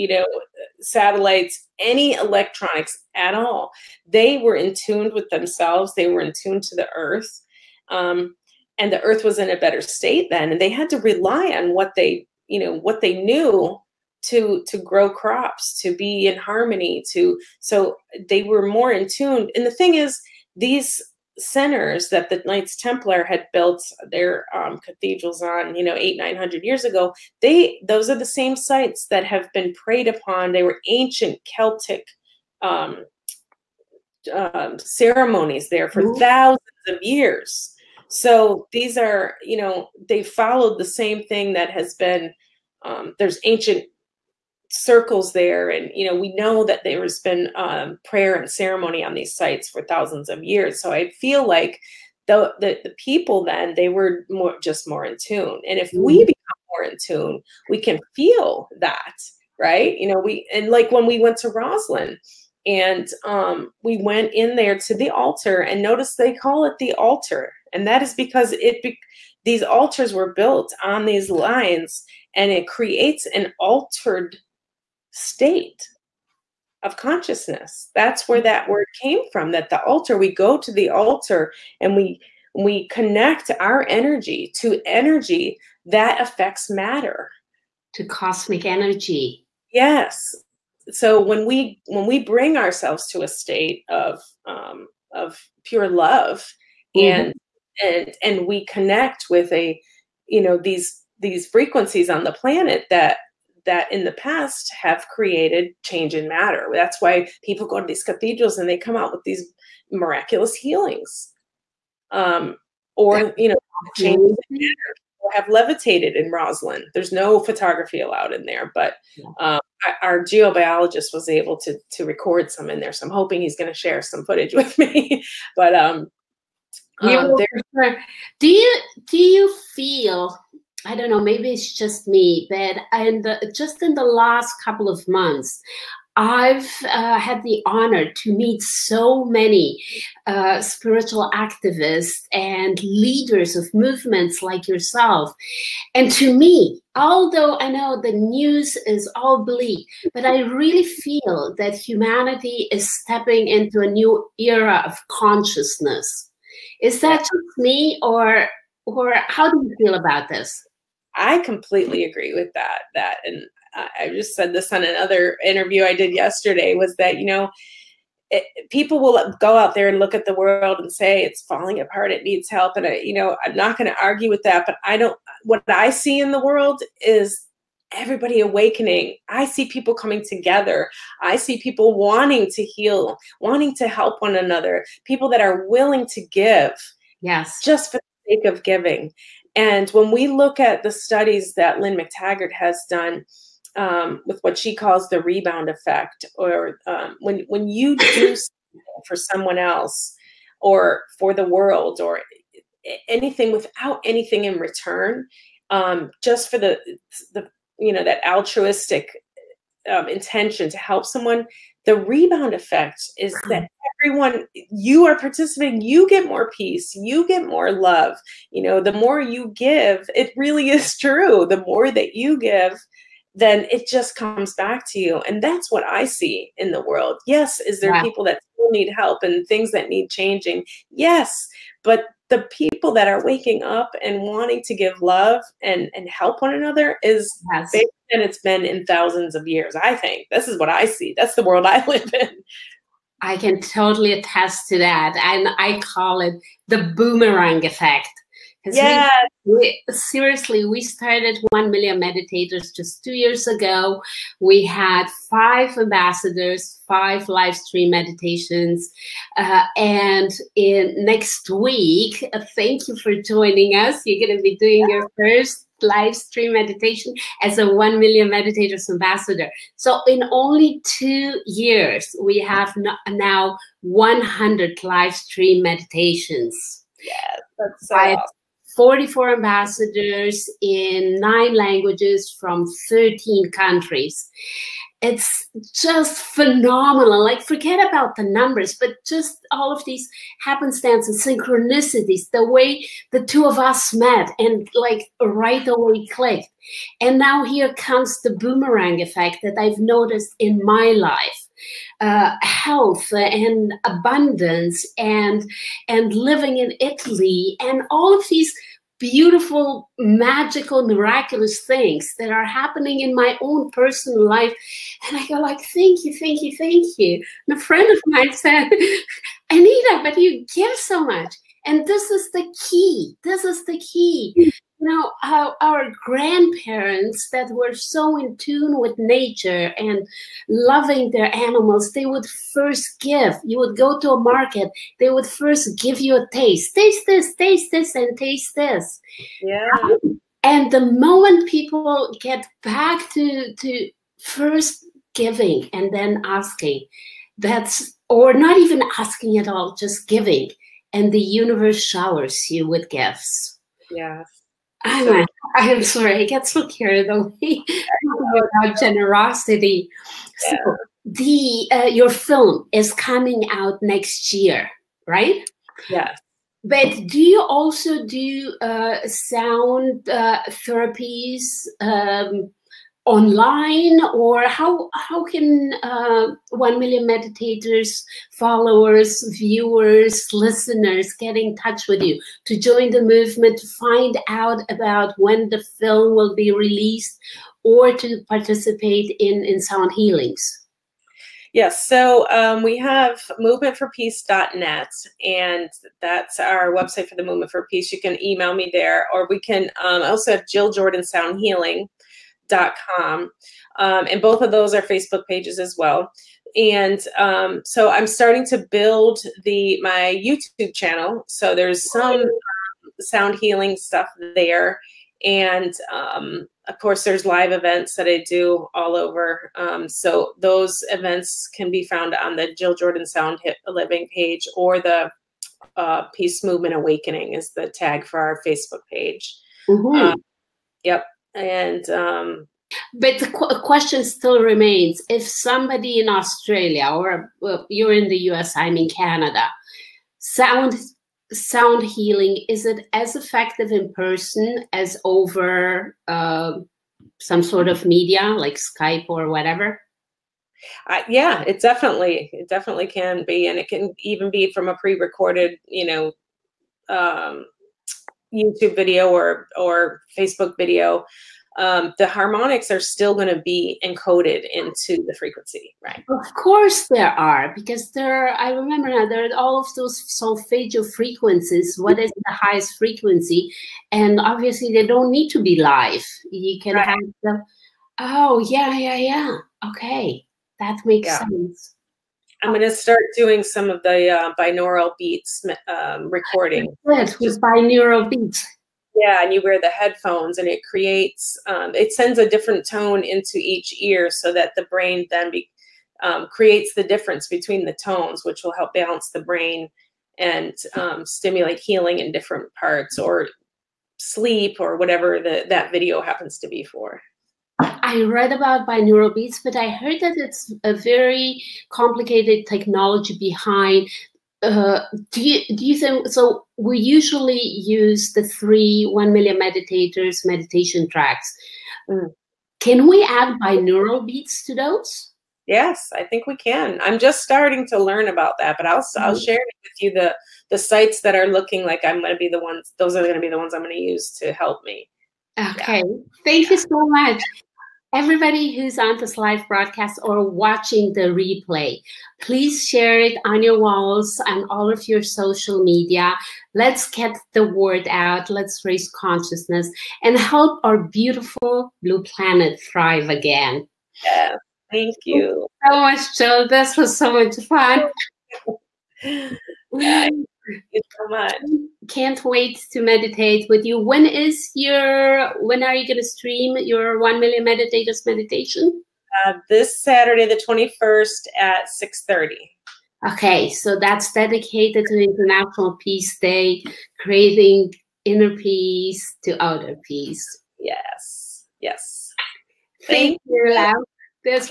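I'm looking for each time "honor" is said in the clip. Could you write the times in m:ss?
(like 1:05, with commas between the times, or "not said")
2:17.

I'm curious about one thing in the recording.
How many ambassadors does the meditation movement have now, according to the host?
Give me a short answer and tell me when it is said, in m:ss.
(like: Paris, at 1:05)
44, at 4:38.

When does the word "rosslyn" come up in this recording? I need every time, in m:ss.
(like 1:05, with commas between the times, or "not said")
1:01, 1:56.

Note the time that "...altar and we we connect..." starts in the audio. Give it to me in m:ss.
1:20.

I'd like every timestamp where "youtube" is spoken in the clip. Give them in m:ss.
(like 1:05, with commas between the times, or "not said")
6:50, 7:38.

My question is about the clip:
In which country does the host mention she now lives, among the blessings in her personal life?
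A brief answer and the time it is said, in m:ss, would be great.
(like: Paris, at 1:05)
Italy, at 5:06.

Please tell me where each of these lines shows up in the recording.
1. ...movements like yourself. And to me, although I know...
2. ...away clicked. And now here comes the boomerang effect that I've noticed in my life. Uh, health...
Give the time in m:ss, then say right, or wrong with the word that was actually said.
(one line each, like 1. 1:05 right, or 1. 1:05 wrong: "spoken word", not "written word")
1. 2:23 right
2. 4:55 right.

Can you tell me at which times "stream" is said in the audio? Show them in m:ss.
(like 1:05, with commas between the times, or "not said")
4:17, 4:26, 4:35, 9:26.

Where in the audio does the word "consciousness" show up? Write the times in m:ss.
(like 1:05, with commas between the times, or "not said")
1:16, 2:35, 9:08.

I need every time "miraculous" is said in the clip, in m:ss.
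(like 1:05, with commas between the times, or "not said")
1:49, 5:10.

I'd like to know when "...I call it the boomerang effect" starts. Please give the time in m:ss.
4:05.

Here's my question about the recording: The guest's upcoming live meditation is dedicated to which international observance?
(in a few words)
International Peace Day.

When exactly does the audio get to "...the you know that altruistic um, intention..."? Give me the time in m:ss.
3:27.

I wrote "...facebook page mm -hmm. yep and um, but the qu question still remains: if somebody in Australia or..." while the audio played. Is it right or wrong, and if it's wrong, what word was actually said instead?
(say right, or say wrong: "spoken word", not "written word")
right.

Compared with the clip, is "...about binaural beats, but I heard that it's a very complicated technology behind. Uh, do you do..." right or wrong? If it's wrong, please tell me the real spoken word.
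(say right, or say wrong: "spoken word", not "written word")
right.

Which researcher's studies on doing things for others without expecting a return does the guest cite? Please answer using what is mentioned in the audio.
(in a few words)
Lynne McTaggart.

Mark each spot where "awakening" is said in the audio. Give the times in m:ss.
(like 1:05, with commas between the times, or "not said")
2:58, 7:06.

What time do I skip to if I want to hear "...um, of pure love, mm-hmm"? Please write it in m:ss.
1:34.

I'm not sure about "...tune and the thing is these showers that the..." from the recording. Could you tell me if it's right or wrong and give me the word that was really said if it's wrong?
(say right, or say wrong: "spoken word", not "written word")
wrong: "centers", not "showers".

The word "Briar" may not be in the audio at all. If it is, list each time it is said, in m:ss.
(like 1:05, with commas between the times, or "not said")
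not said.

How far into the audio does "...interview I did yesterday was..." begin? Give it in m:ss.
2:45.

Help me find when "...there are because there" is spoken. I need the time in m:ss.
7:46.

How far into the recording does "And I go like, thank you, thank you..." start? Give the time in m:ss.
5:15.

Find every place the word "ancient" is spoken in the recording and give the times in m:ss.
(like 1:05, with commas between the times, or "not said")
0:30, 0:43.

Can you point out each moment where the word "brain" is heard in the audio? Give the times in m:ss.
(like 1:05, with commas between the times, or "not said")
8:14, 8:19.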